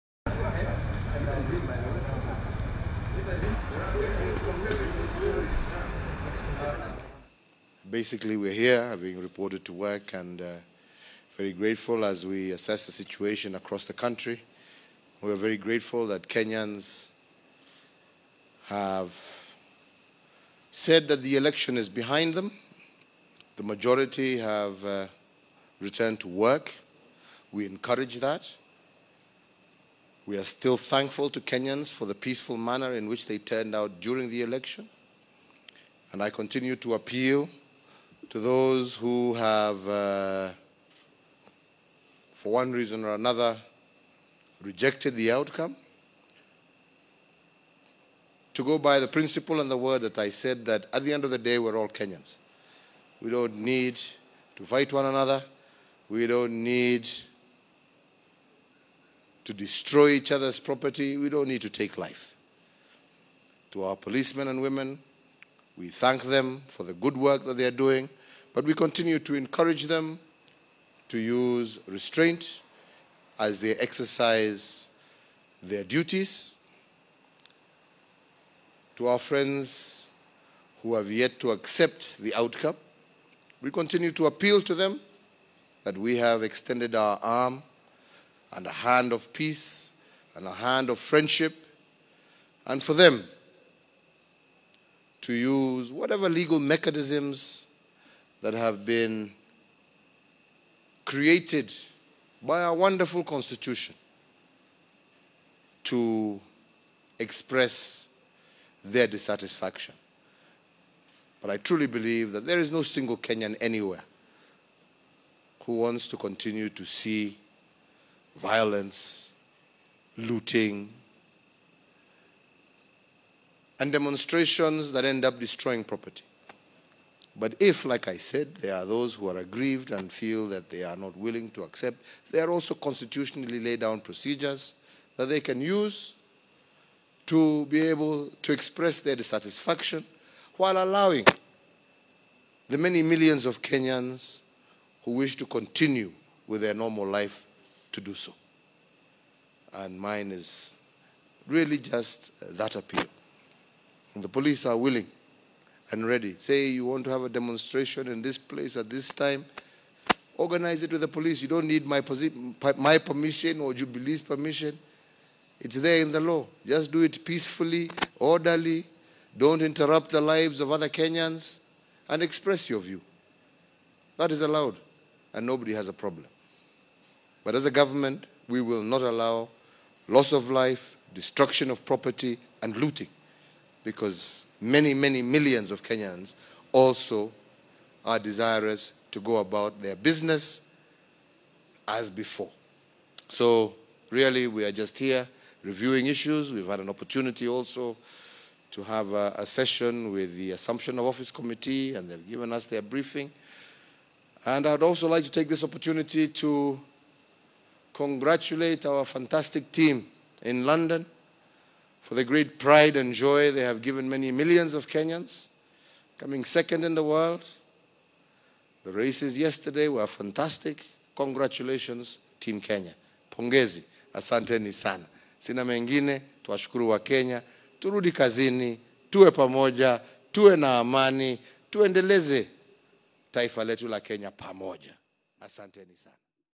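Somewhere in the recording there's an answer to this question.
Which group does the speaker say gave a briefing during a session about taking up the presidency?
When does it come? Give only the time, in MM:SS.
03:20.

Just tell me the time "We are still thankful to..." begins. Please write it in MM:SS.
00:30.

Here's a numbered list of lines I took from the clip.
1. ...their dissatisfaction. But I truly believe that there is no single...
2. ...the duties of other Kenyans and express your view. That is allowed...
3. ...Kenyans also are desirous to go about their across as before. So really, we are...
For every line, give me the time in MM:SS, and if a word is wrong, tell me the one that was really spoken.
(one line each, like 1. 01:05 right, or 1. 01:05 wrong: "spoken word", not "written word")
1. 01:48 right
2. 02:50 wrong: "lives", not "duties"
3. 03:05 wrong: "business", not "across".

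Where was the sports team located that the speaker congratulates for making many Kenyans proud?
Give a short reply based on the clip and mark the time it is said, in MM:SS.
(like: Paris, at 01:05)
London, at 03:30.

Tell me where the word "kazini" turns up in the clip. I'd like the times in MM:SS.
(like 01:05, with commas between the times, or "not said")
03:48.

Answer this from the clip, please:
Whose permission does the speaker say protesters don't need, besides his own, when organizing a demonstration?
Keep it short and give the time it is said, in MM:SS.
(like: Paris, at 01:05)
Jubilee's, at 02:43.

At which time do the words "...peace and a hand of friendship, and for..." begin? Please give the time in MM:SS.
01:29.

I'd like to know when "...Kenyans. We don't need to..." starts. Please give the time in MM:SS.
00:51.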